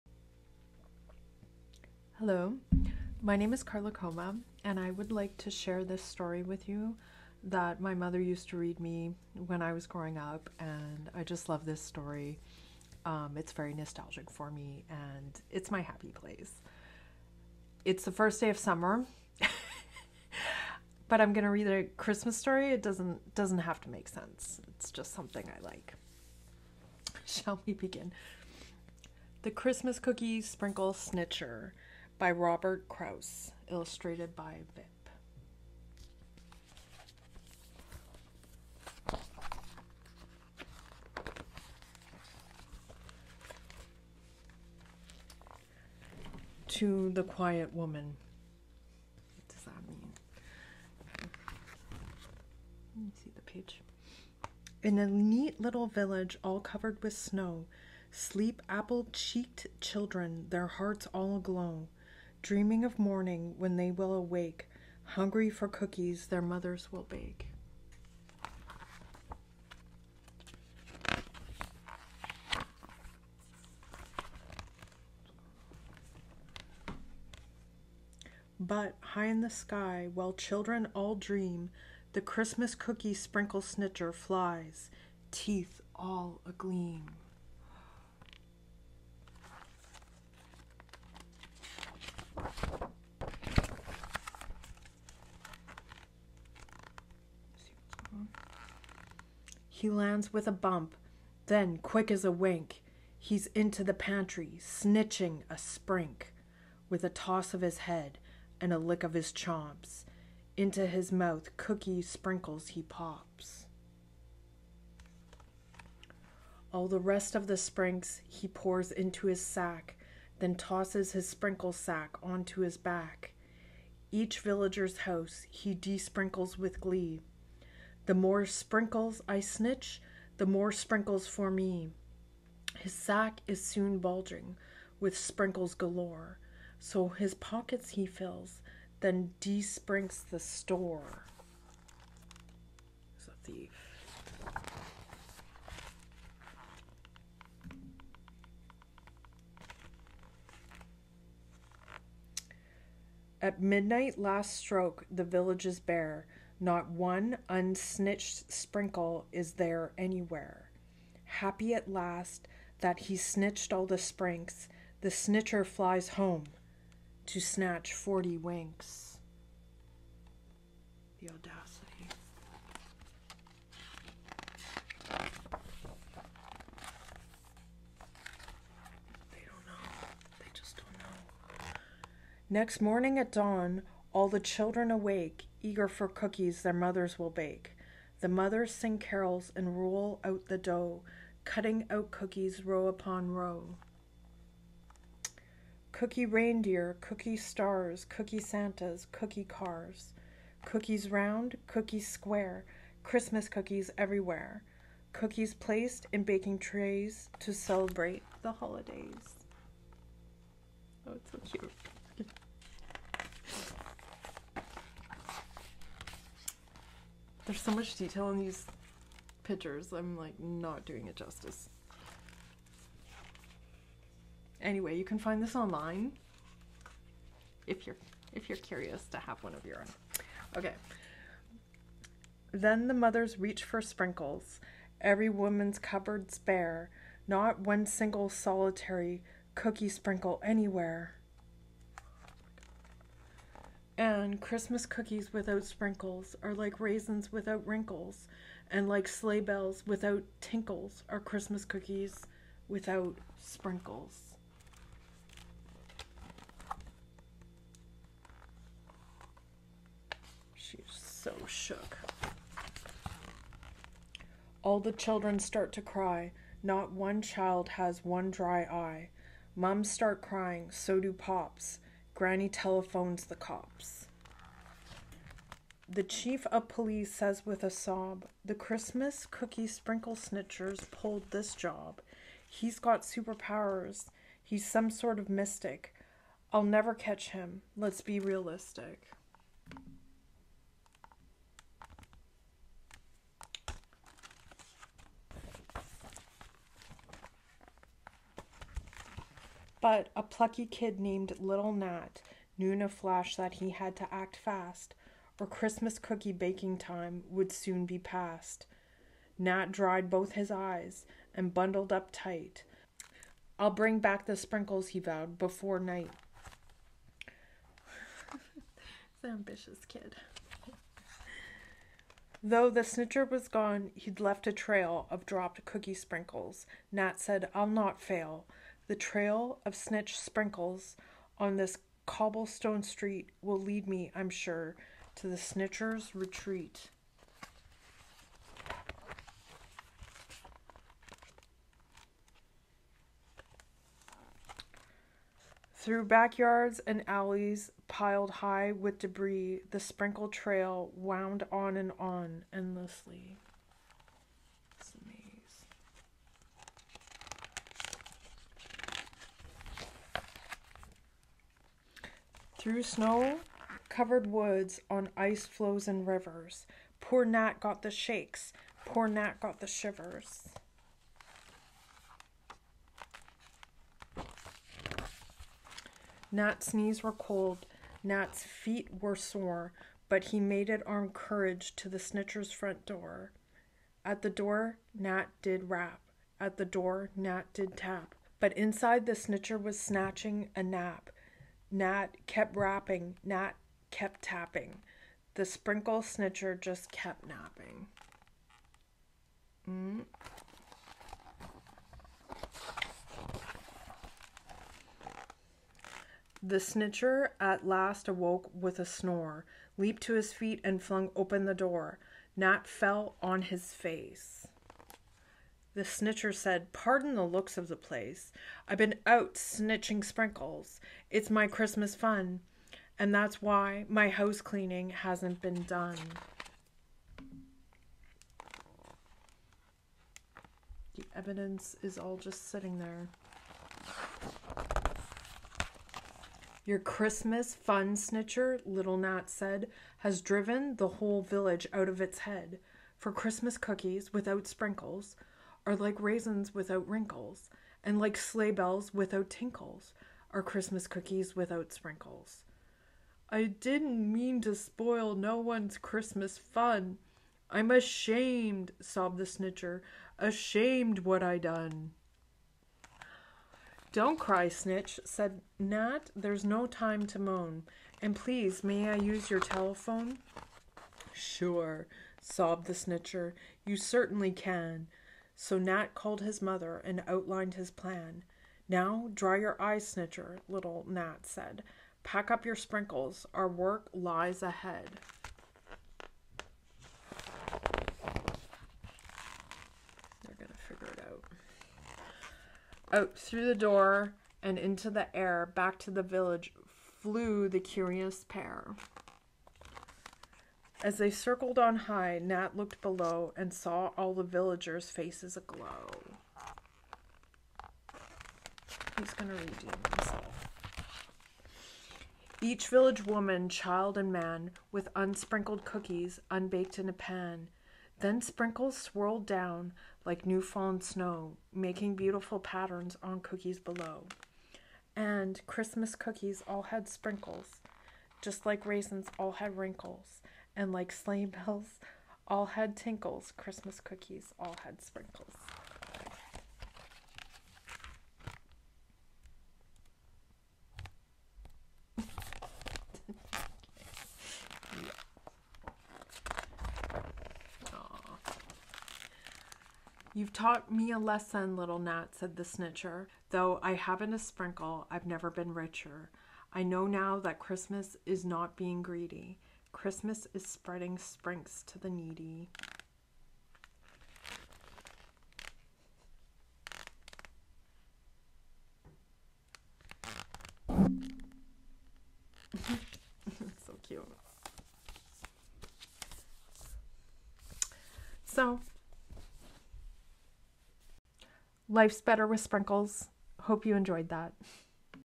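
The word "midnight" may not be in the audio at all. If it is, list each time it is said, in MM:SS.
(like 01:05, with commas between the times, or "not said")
02:33.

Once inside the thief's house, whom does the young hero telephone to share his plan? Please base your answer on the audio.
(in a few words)
His mother.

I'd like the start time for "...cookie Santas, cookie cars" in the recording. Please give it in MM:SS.
03:18.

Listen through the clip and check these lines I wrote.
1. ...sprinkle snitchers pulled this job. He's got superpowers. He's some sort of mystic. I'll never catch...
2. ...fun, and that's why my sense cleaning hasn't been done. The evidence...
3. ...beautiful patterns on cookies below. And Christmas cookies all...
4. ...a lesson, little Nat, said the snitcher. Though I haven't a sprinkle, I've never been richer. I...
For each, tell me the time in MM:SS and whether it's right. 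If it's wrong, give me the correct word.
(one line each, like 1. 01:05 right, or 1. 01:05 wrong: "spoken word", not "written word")
1. 04:39 right
2. 07:01 wrong: "house", not "sense"
3. 08:41 right
4. 09:10 right.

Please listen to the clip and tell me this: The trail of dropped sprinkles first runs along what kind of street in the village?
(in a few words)
Cobblestone street.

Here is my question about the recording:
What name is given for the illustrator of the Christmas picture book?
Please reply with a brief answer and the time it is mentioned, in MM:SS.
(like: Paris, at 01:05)
Vip, at 00:34.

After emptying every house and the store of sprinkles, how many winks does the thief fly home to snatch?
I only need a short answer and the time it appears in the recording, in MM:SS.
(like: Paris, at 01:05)
40, at 02:47.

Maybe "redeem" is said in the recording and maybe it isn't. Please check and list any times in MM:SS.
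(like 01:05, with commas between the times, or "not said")
08:29.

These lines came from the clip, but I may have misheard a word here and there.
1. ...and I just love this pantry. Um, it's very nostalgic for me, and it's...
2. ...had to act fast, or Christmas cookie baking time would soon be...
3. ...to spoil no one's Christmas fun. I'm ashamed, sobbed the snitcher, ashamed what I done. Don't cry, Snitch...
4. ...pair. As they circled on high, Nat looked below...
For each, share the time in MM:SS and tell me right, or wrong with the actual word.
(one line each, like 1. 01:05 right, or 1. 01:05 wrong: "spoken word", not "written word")
1. 00:10 wrong: "story", not "pantry"
2. 05:03 right
3. 07:34 right
4. 08:18 right.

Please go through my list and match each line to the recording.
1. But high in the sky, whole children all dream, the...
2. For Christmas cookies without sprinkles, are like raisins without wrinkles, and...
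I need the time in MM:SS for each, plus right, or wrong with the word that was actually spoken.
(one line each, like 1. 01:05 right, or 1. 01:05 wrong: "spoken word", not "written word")
1. 01:18 wrong: "while", not "whole"
2. 07:22 right.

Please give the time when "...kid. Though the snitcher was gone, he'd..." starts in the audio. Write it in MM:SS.
05:19.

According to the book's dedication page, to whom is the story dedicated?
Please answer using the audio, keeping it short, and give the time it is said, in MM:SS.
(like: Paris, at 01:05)
The Quiet Woman, at 00:47.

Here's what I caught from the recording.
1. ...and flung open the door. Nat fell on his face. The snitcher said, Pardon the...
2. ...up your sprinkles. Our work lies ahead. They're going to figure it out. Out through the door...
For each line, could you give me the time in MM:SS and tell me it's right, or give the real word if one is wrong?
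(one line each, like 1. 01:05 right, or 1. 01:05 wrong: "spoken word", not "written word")
1. 06:50 right
2. 08:02 right.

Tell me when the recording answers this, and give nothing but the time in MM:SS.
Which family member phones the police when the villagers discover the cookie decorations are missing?
04:32.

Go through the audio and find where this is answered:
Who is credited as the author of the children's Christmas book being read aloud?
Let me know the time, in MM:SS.
00:32.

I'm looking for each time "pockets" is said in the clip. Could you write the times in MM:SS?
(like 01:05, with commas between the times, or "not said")
02:17.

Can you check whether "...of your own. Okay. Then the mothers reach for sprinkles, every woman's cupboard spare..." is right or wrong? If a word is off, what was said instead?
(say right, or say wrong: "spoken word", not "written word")
right.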